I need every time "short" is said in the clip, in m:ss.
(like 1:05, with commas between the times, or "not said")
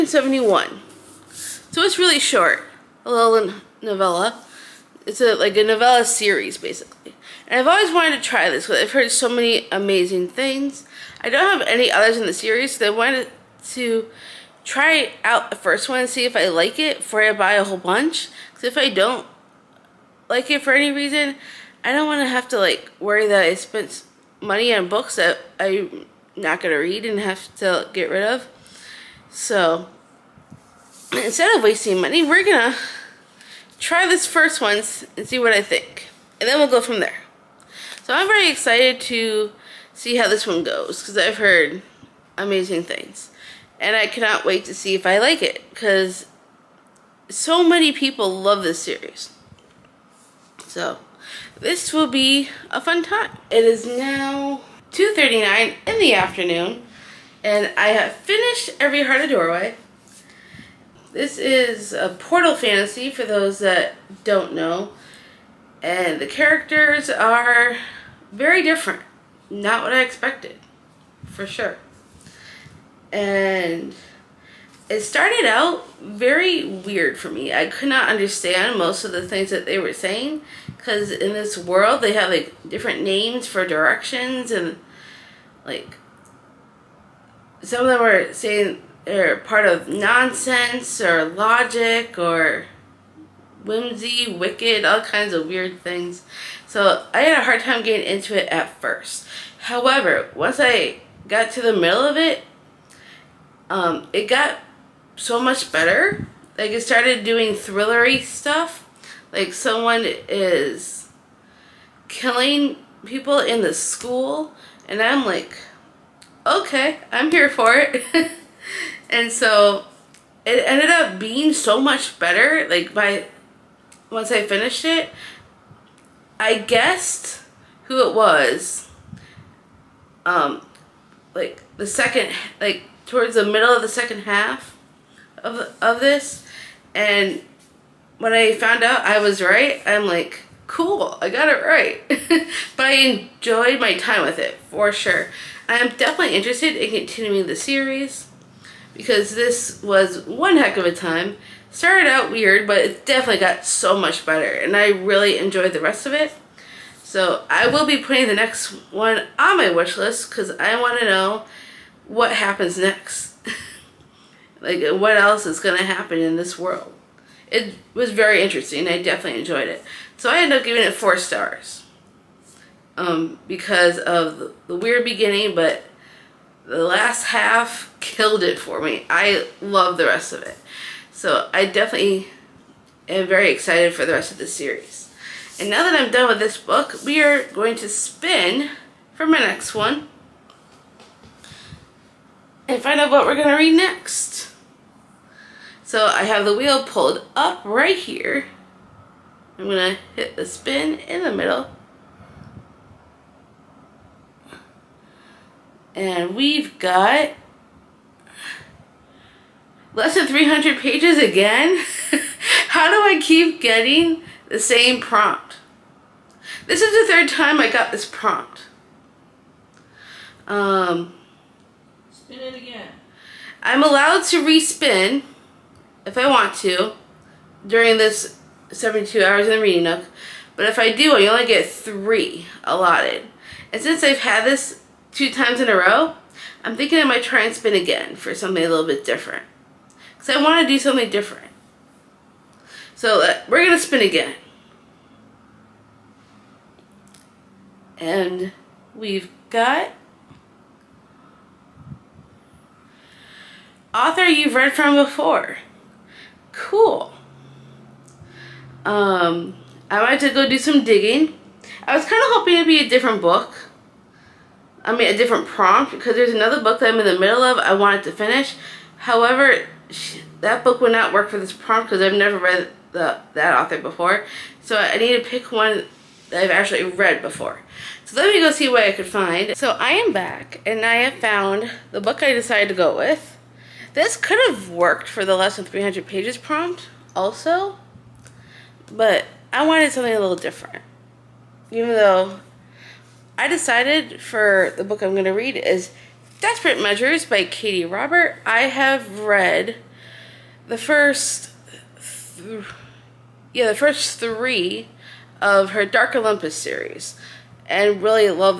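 0:02.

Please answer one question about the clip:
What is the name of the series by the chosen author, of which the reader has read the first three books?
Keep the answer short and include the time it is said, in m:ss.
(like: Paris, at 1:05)
Dark Olympus, at 5:05.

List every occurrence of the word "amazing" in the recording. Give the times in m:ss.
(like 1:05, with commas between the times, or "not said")
0:09, 0:42.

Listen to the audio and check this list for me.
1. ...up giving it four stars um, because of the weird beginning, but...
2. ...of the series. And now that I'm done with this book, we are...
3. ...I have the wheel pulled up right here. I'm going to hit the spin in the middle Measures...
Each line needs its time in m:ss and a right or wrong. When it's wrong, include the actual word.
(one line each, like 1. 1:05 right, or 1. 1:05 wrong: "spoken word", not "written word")
1. 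2:50 right
2. 3:04 right
3. 3:16 wrong: "And", not "Measures".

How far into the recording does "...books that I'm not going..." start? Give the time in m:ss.
0:24.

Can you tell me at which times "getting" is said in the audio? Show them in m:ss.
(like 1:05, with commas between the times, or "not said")
1:37, 3:33.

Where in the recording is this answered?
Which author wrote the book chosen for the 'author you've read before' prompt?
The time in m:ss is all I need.
4:57.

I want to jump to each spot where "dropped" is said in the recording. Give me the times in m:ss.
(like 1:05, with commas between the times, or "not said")
not said.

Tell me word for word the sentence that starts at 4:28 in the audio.
However, she, that book would not work for this prompt because I've never read the that author before.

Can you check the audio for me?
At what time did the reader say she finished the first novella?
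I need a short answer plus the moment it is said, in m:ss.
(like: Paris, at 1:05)
2:39 in the afternoon, at 0:54.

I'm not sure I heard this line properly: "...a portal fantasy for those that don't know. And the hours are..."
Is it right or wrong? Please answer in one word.
wrong.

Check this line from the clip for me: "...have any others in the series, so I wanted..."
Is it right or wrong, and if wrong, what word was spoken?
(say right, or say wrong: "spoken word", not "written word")
right.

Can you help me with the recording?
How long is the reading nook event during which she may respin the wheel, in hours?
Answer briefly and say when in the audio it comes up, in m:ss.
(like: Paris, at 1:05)
72, at 3:48.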